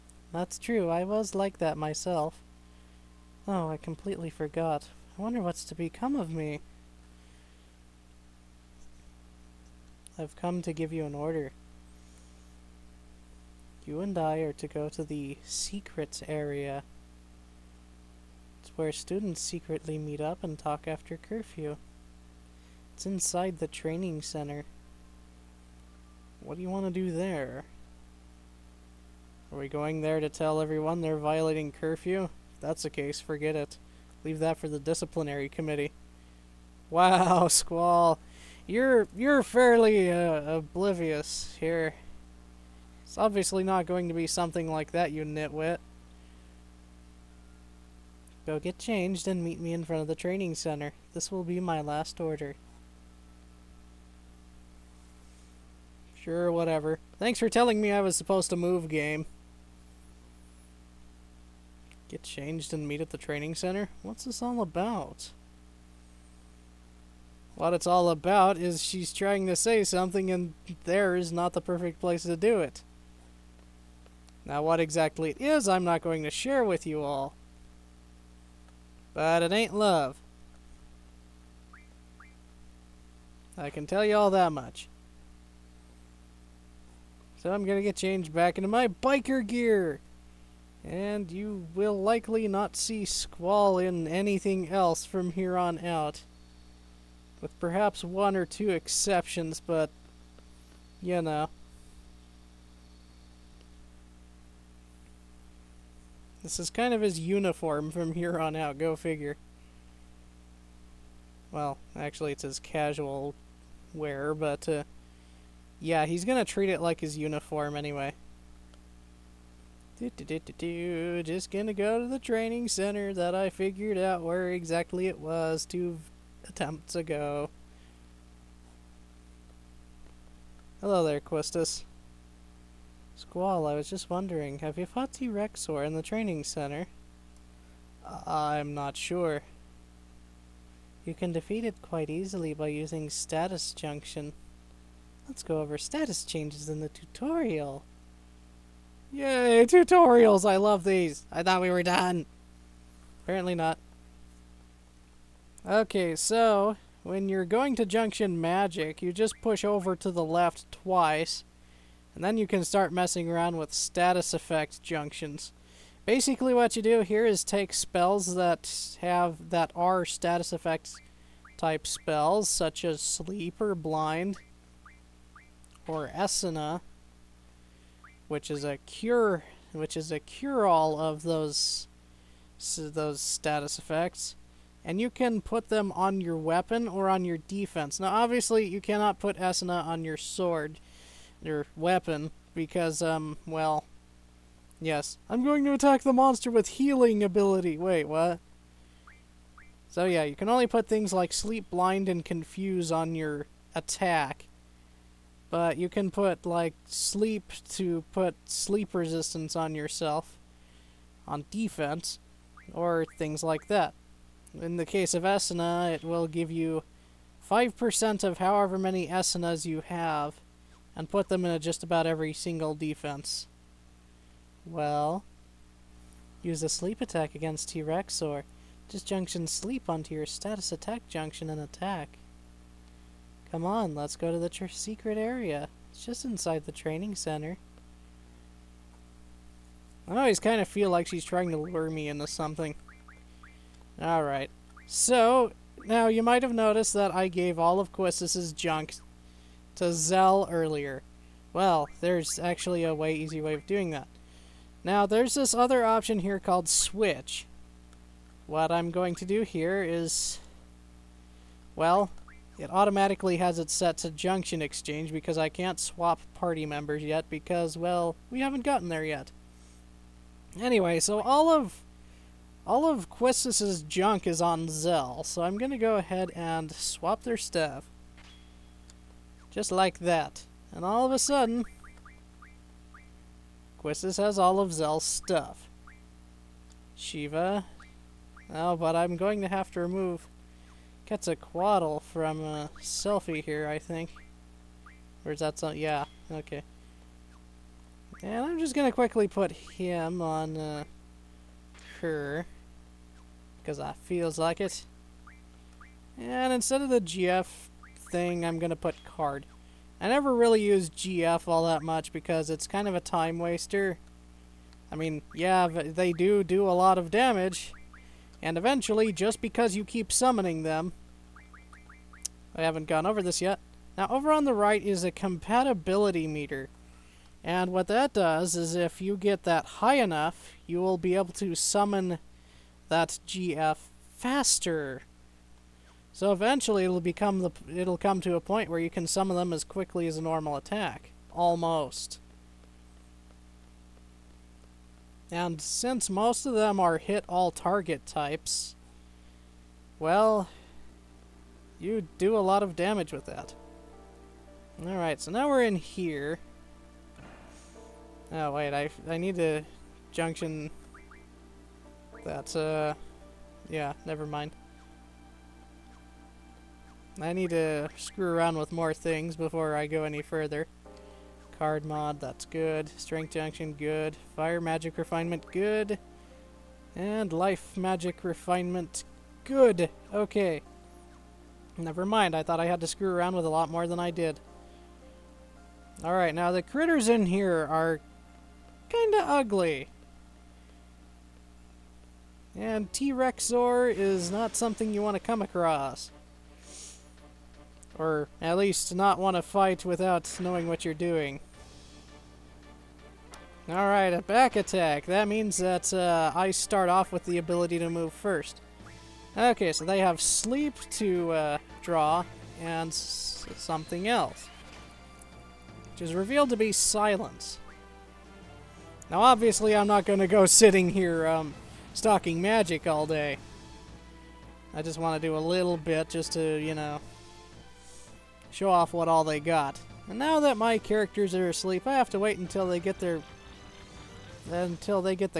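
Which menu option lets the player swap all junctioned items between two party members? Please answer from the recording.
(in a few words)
Switch.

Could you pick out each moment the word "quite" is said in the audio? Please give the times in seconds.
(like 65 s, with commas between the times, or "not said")
141 s.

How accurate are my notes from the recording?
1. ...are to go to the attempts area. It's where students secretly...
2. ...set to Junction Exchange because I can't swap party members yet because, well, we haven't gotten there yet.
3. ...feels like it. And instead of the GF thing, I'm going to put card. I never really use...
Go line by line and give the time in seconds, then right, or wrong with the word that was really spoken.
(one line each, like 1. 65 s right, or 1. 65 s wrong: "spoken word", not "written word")
1. 14 s wrong: "secrets", not "attempts"
2. 263 s right
3. 303 s right.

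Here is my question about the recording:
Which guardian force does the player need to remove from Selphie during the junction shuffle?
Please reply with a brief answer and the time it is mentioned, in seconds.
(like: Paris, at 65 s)
Quetzalcoatl, at 291 s.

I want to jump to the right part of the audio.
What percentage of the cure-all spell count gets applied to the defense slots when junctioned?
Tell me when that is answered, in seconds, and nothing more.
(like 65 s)
217 s.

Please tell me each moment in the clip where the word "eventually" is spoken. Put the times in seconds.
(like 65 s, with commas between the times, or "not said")
318 s, 336 s.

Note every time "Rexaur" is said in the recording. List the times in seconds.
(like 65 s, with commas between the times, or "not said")
135 s, 392 s.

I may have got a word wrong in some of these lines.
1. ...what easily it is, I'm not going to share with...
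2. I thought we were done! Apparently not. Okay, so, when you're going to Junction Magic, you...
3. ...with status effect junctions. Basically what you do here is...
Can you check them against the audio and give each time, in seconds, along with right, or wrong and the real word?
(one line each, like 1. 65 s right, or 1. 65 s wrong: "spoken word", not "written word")
1. 74 s wrong: "exactly", not "easily"
2. 151 s right
3. 163 s right.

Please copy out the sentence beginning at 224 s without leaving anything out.
Well, use a sleep attack against T-Rex or just junction sleep onto your status attack junction and attack.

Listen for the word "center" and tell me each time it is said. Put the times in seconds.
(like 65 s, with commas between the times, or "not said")
24 s, 50 s, 63 s, 122 s, 136 s, 237 s.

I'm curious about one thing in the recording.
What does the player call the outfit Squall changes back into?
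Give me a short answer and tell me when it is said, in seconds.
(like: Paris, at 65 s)
biker gear, at 88 s.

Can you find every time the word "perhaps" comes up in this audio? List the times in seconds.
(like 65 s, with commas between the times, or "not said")
97 s.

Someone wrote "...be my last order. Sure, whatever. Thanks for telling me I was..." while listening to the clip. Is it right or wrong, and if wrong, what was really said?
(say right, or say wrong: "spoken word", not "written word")
right.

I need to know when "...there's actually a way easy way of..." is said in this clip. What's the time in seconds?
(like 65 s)
252 s.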